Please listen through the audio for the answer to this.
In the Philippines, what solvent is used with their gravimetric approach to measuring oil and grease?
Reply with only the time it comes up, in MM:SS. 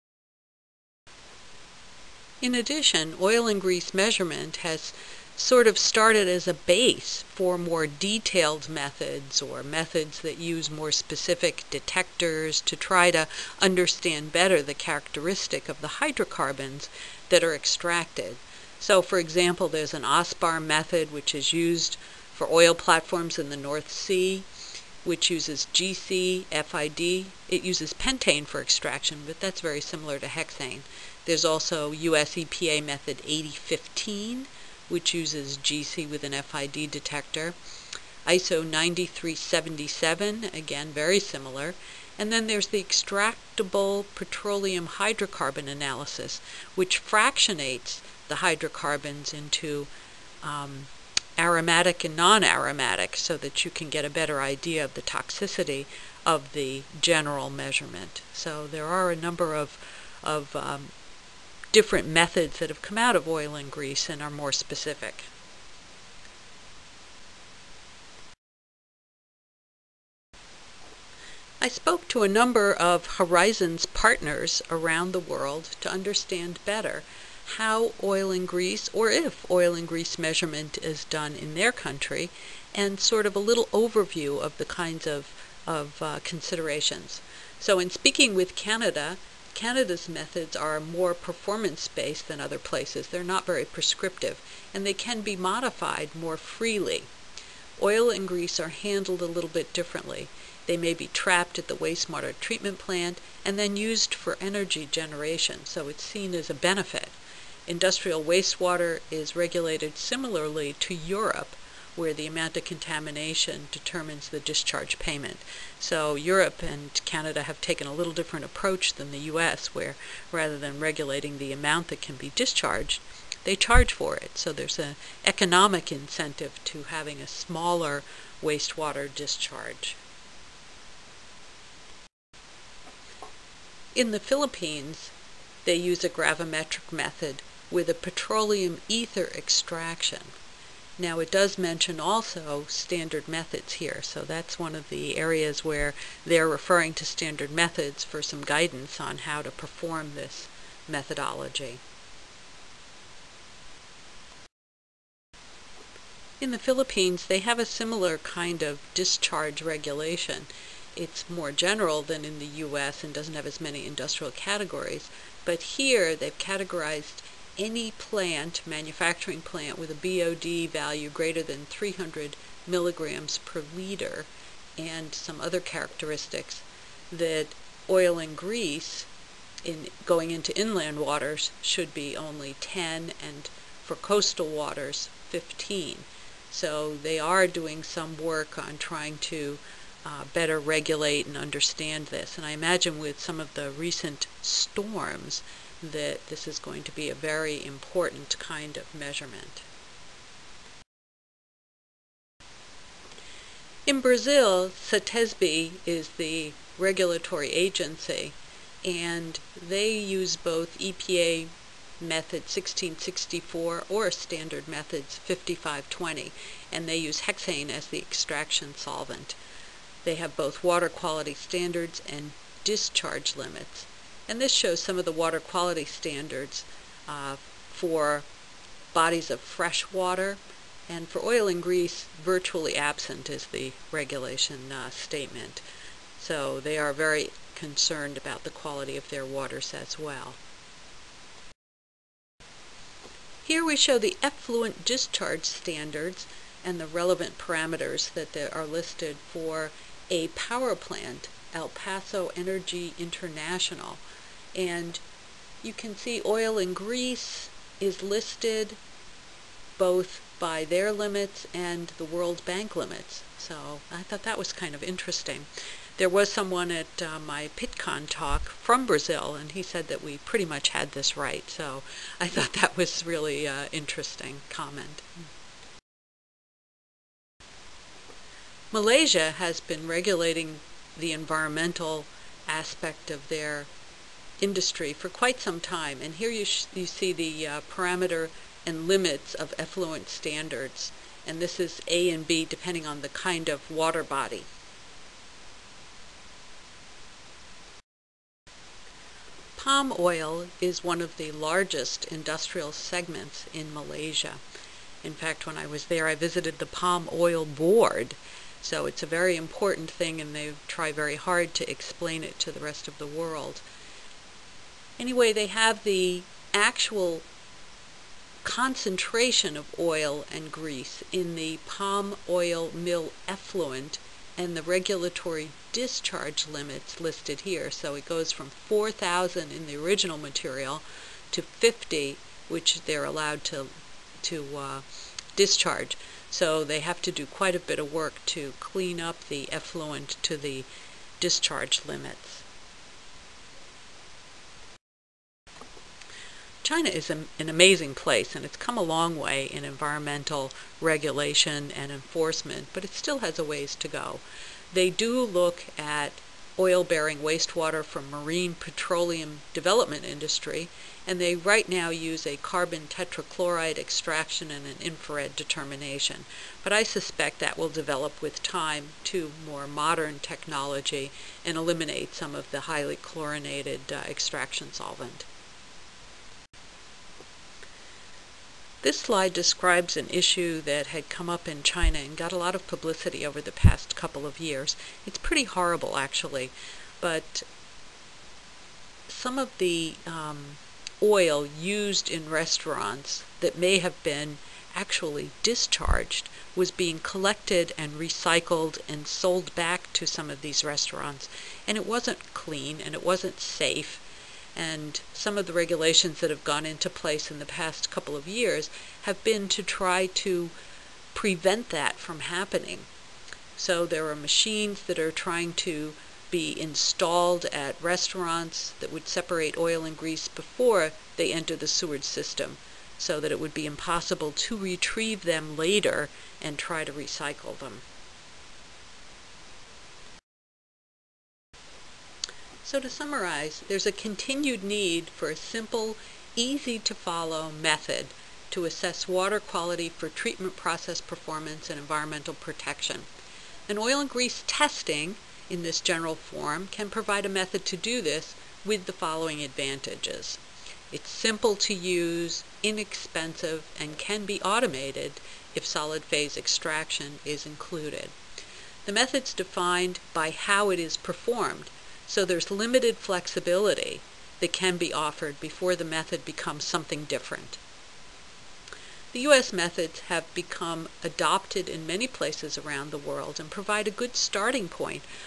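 02:17.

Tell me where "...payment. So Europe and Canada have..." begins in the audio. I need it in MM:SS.
01:54.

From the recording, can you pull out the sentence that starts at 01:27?
So in speaking with Canada, Canada's methods are more performance-based than other places.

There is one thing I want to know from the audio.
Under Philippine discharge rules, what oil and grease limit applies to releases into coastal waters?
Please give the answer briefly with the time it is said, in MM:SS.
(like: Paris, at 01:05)
15, at 03:05.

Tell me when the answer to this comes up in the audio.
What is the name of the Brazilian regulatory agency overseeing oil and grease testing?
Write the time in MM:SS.
03:24.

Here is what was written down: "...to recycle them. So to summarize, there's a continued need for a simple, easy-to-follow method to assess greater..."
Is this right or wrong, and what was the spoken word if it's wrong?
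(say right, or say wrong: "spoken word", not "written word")
wrong: "water", not "greater".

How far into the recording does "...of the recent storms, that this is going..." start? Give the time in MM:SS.
03:13.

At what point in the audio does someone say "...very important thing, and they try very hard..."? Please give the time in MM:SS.
05:09.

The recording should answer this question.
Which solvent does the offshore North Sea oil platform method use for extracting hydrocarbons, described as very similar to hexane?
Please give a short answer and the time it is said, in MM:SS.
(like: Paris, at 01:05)
pentane, at 00:27.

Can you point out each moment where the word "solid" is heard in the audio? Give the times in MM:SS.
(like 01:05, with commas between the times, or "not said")
07:35.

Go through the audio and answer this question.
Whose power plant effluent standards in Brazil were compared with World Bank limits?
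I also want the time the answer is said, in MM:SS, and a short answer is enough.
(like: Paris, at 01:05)
El Paso Energy International, at 04:11.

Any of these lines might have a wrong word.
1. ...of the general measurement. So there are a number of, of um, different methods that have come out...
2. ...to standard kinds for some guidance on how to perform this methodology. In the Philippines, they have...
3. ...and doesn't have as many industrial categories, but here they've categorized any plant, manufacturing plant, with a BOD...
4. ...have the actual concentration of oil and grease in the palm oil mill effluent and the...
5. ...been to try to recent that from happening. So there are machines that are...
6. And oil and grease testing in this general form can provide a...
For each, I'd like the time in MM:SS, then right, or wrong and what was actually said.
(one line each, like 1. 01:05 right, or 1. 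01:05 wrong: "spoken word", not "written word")
1. 00:56 right
2. 02:26 wrong: "methods", not "kinds"
3. 02:43 right
4. 05:15 right
5. 06:49 wrong: "prevent", not "recent"
6. 07:23 right.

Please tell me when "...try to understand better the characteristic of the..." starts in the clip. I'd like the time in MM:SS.
00:12.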